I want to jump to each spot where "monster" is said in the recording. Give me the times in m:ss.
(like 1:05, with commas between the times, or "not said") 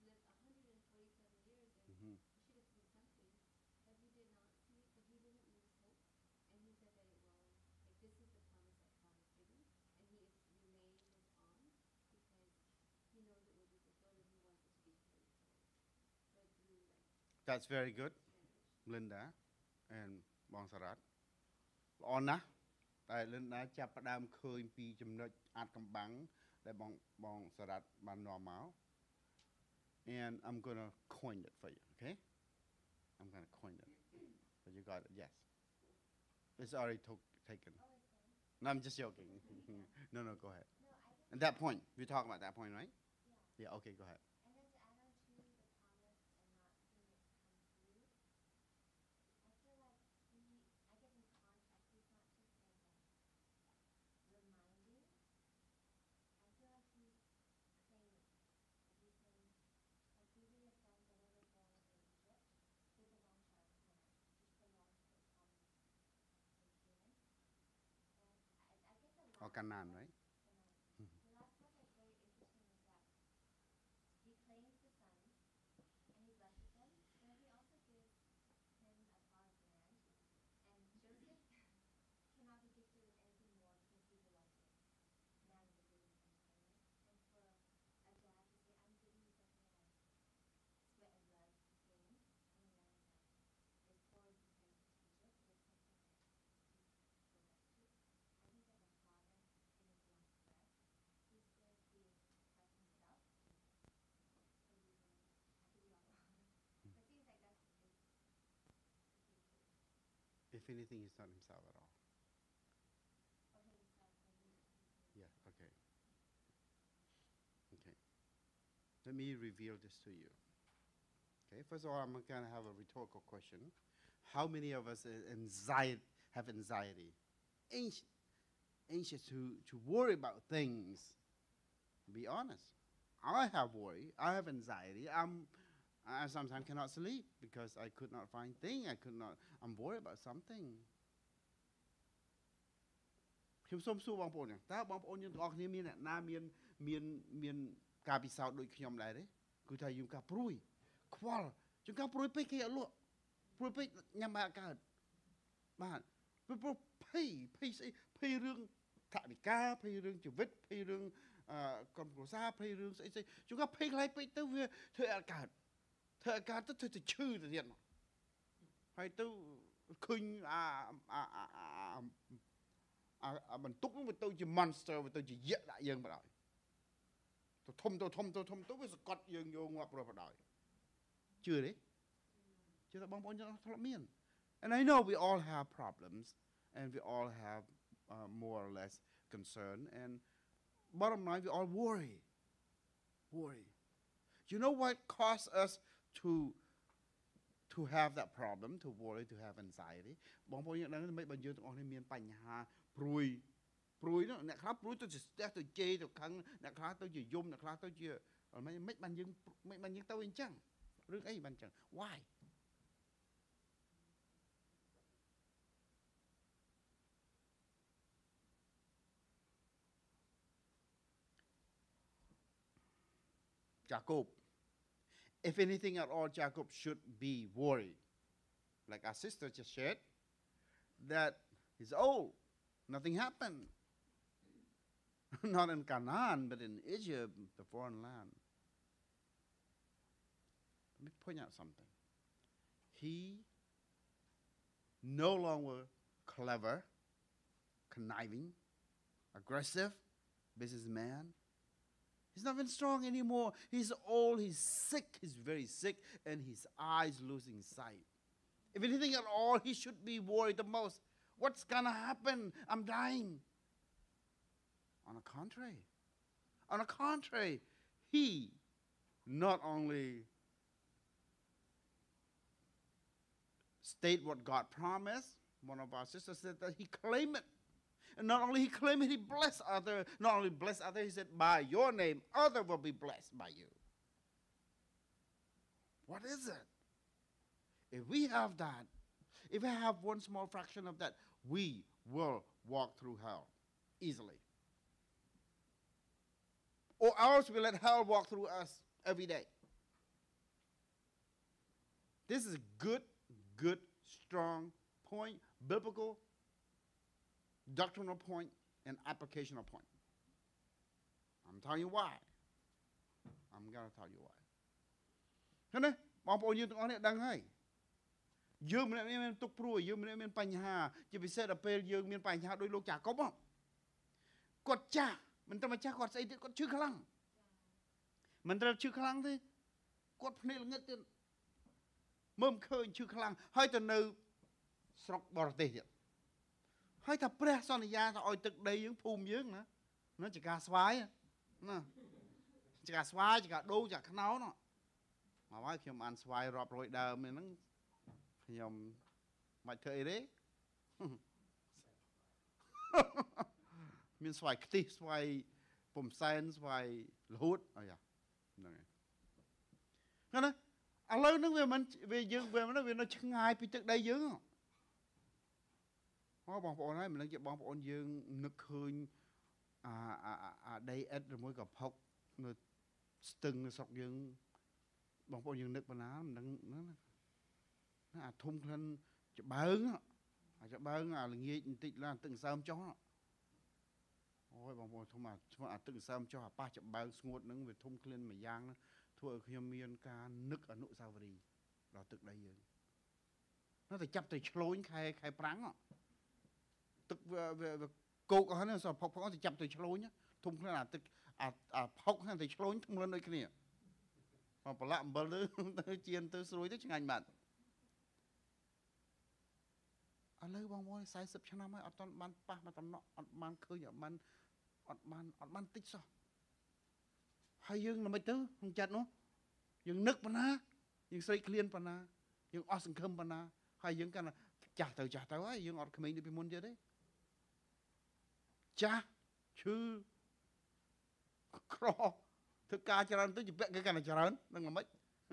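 2:54.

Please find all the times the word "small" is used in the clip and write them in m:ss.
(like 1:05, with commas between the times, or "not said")
4:50.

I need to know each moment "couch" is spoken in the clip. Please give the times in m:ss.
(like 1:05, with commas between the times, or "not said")
not said.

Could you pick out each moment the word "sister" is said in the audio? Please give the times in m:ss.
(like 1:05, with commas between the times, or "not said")
3:49, 4:36.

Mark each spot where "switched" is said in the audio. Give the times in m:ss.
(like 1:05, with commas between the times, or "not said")
not said.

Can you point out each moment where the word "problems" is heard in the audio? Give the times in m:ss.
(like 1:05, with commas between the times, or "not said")
3:05, 3:18.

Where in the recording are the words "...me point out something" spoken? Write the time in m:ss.
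4:01.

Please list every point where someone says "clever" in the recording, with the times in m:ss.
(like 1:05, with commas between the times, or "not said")
4:06.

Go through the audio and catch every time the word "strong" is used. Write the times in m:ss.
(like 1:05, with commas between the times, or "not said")
4:12, 5:04.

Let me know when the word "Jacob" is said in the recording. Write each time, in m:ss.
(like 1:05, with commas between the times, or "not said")
3:46.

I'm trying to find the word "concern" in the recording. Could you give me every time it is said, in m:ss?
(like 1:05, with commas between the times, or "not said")
3:09.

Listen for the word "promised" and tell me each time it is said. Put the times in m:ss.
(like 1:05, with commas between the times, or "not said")
4:34.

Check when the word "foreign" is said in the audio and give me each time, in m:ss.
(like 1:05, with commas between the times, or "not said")
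3:57.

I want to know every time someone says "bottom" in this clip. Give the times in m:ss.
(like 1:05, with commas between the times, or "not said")
3:10.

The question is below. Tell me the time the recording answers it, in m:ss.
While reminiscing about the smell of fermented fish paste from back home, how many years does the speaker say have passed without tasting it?
6:51.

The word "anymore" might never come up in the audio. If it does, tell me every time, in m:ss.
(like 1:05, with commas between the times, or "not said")
4:13.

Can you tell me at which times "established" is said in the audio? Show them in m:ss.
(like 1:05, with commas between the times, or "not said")
not said.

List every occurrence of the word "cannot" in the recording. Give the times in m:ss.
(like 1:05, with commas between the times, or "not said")
2:16.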